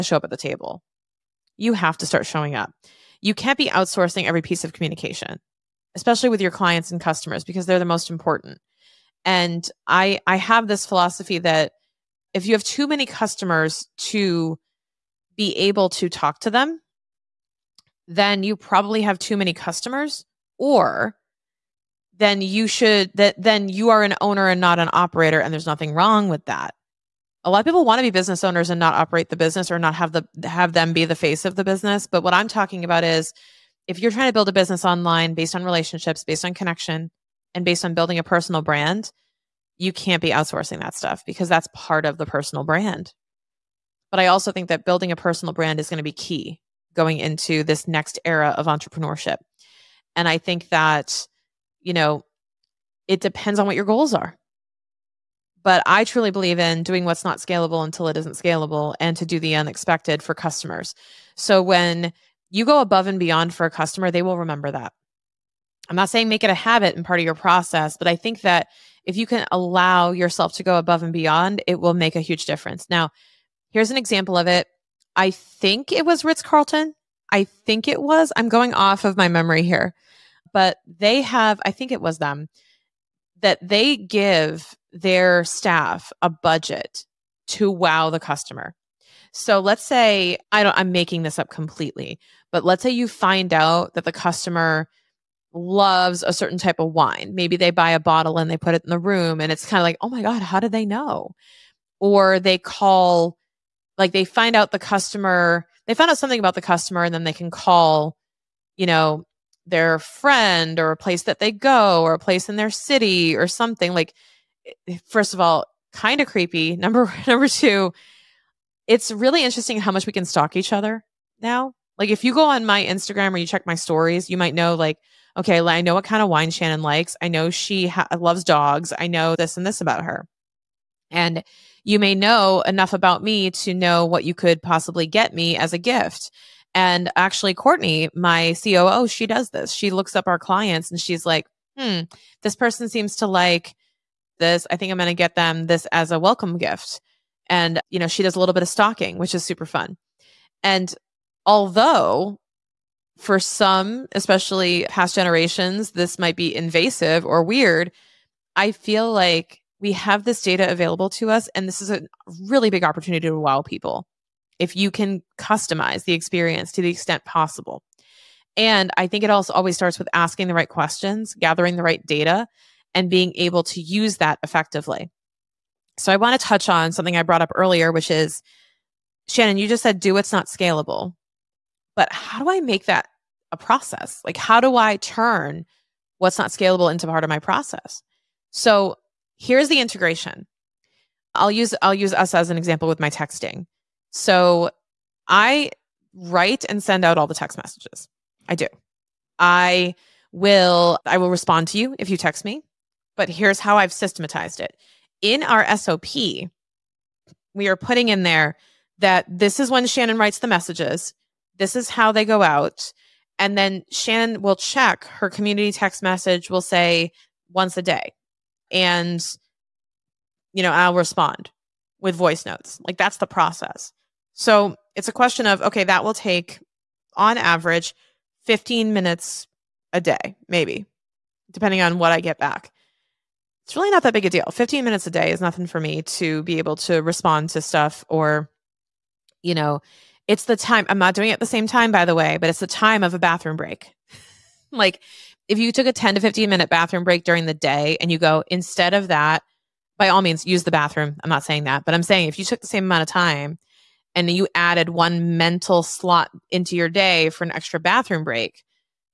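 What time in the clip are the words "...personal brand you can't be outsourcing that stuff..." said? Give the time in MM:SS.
00:38.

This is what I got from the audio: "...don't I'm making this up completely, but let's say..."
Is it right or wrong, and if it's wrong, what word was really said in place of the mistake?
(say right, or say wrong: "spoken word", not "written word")
right.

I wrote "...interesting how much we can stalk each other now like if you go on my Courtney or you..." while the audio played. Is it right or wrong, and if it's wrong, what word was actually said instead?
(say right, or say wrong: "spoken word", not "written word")
wrong: "Instagram", not "Courtney".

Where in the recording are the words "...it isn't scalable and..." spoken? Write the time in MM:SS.
00:58.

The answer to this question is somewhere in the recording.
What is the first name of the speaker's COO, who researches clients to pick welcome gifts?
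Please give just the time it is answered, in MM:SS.
02:17.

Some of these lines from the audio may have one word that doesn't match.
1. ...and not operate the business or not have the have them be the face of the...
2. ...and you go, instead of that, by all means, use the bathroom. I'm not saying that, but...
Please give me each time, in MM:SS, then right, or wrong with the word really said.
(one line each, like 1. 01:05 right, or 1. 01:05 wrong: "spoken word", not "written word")
1. 00:28 right
2. 04:07 right.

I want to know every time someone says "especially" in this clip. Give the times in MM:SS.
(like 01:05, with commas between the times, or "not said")
00:05, 02:34.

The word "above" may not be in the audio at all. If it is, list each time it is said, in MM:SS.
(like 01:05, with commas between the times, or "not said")
01:02, 01:10.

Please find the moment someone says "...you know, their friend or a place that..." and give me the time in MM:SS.
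01:48.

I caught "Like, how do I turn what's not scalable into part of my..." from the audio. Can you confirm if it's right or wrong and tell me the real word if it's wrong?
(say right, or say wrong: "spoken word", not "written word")
right.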